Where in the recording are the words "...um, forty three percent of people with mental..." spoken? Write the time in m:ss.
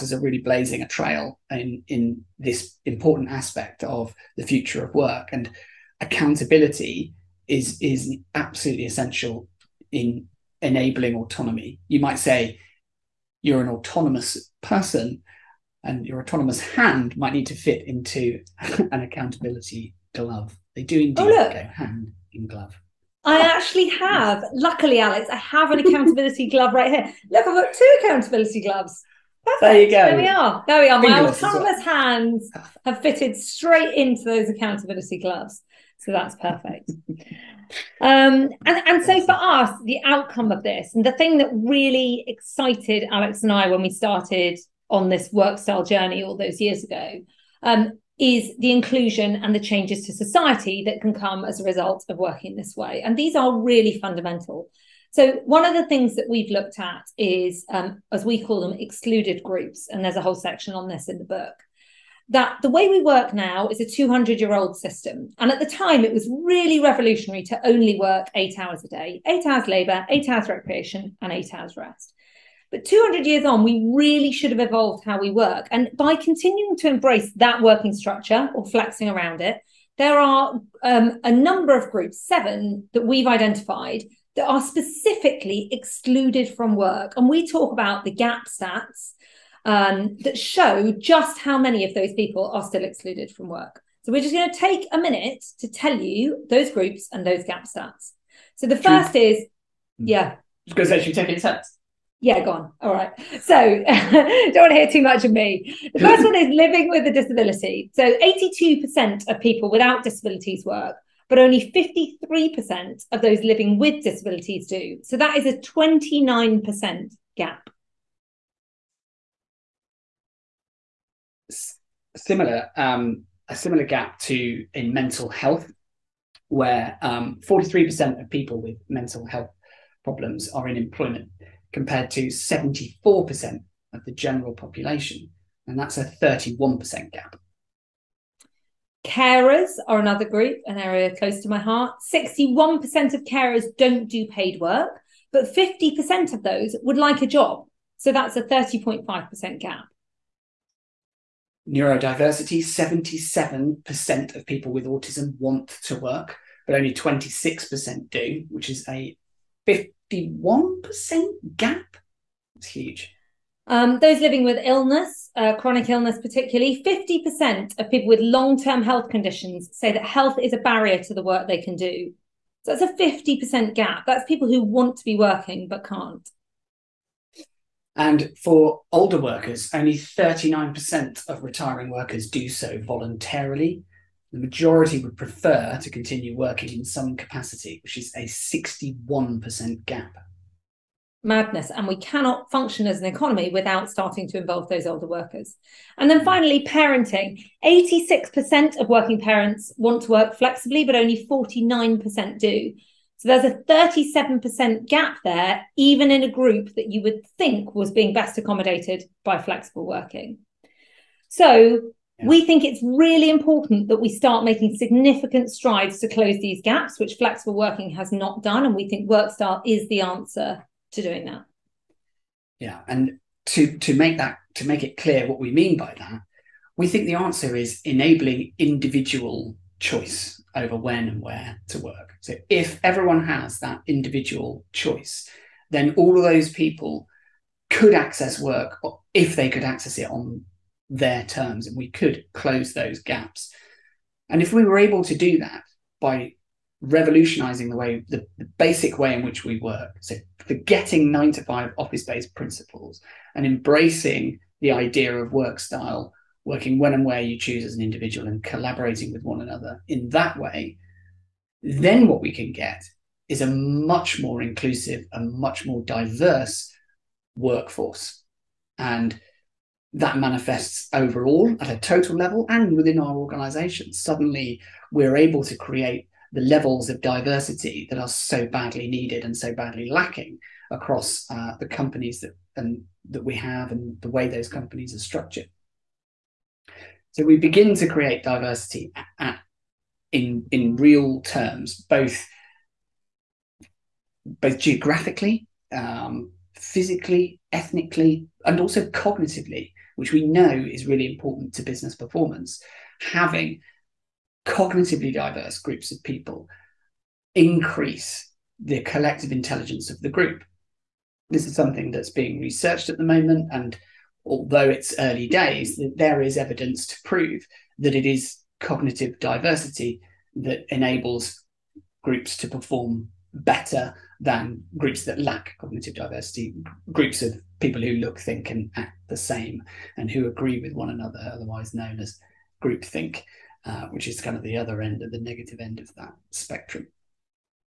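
2:07.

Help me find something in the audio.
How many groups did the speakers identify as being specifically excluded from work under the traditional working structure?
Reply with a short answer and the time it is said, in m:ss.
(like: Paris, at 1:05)
7, at 1:22.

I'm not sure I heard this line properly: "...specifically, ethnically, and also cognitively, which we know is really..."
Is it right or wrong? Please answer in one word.
wrong.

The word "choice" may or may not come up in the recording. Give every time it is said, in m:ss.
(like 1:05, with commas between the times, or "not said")
3:49, 3:54.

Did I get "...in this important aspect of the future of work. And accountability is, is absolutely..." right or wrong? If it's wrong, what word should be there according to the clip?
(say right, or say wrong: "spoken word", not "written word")
right.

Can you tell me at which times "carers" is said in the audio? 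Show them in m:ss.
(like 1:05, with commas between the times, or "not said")
2:19, 2:23.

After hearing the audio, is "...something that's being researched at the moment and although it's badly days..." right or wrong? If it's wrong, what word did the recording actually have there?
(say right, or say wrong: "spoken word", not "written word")
wrong: "early", not "badly".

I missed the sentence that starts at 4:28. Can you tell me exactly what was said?
And that manifests overall at a total level and within our organizations.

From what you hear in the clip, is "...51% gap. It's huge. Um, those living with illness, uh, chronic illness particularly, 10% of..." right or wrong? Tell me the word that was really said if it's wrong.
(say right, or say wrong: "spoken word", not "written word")
wrong: "50", not "10".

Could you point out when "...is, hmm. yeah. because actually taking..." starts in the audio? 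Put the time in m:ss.
1:39.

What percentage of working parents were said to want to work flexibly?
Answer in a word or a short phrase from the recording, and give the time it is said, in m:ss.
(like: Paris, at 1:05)
86%, at 3:17.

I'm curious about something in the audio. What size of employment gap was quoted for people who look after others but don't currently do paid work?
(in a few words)
30.5%.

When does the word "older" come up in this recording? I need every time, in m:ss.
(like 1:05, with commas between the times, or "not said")
2:58, 3:14.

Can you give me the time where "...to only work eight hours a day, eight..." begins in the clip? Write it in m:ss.
1:07.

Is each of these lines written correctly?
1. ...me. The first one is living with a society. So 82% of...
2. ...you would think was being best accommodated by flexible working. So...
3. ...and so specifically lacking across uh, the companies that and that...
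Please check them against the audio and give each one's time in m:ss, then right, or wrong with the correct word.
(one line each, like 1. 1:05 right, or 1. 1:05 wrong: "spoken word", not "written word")
1. 1:45 wrong: "disability", not "society"
2. 3:26 right
3. 4:39 wrong: "badly", not "specifically".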